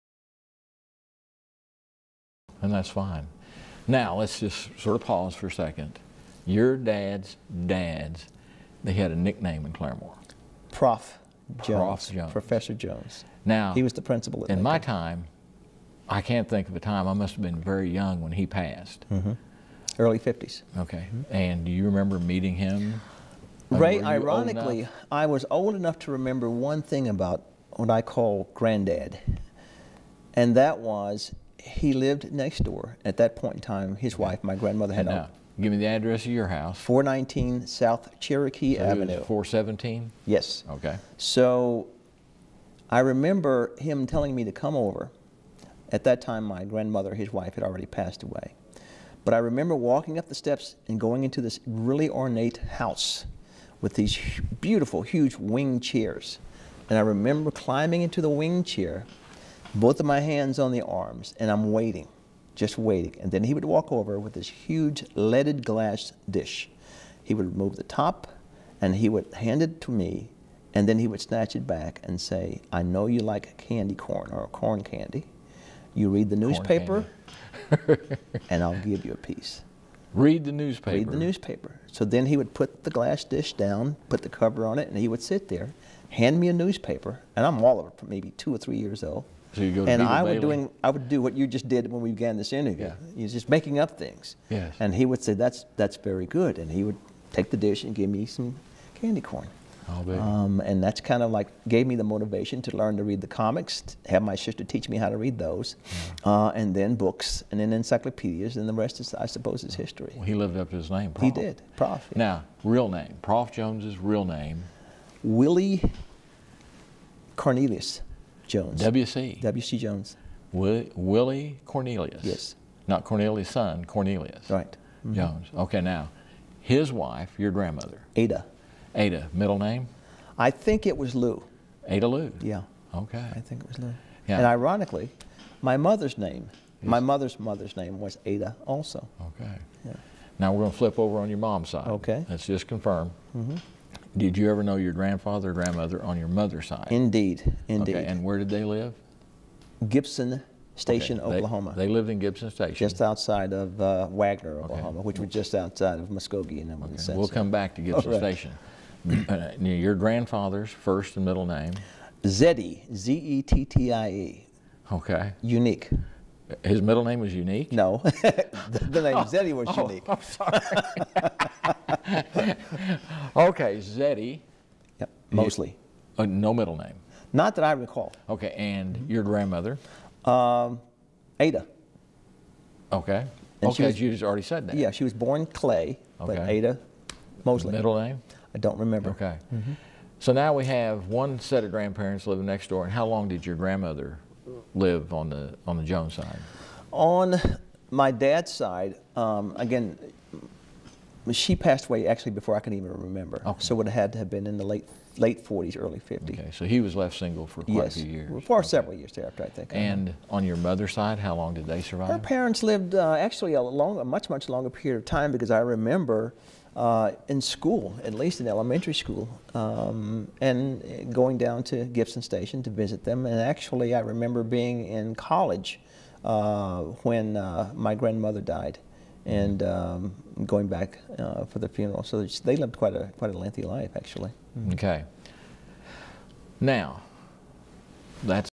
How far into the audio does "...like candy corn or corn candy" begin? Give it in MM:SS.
01:13.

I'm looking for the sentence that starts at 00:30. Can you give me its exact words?
And that was he lived next door.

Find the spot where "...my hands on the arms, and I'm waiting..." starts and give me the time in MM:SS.
01:00.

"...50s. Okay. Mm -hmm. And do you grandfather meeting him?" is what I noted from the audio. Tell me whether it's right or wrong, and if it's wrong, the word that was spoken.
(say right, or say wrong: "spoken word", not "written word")
wrong: "remember", not "grandfather".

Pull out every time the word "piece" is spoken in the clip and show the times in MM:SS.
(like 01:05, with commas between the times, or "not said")
01:19.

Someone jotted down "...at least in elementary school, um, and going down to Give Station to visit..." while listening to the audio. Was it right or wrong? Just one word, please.
wrong.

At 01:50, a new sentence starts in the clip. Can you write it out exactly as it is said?
Well, he lived up to his name, Prof.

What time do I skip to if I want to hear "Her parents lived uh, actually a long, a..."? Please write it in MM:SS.
03:32.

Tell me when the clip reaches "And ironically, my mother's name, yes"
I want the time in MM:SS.
02:14.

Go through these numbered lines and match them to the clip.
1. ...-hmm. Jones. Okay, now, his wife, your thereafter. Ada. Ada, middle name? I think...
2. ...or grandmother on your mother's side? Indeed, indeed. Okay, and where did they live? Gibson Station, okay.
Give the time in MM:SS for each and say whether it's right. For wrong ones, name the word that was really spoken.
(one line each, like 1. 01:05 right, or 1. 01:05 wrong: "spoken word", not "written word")
1. 02:05 wrong: "grandmother", not "thereafter"
2. 02:25 right.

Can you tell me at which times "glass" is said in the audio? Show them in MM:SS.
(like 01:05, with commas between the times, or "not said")
01:05, 01:22.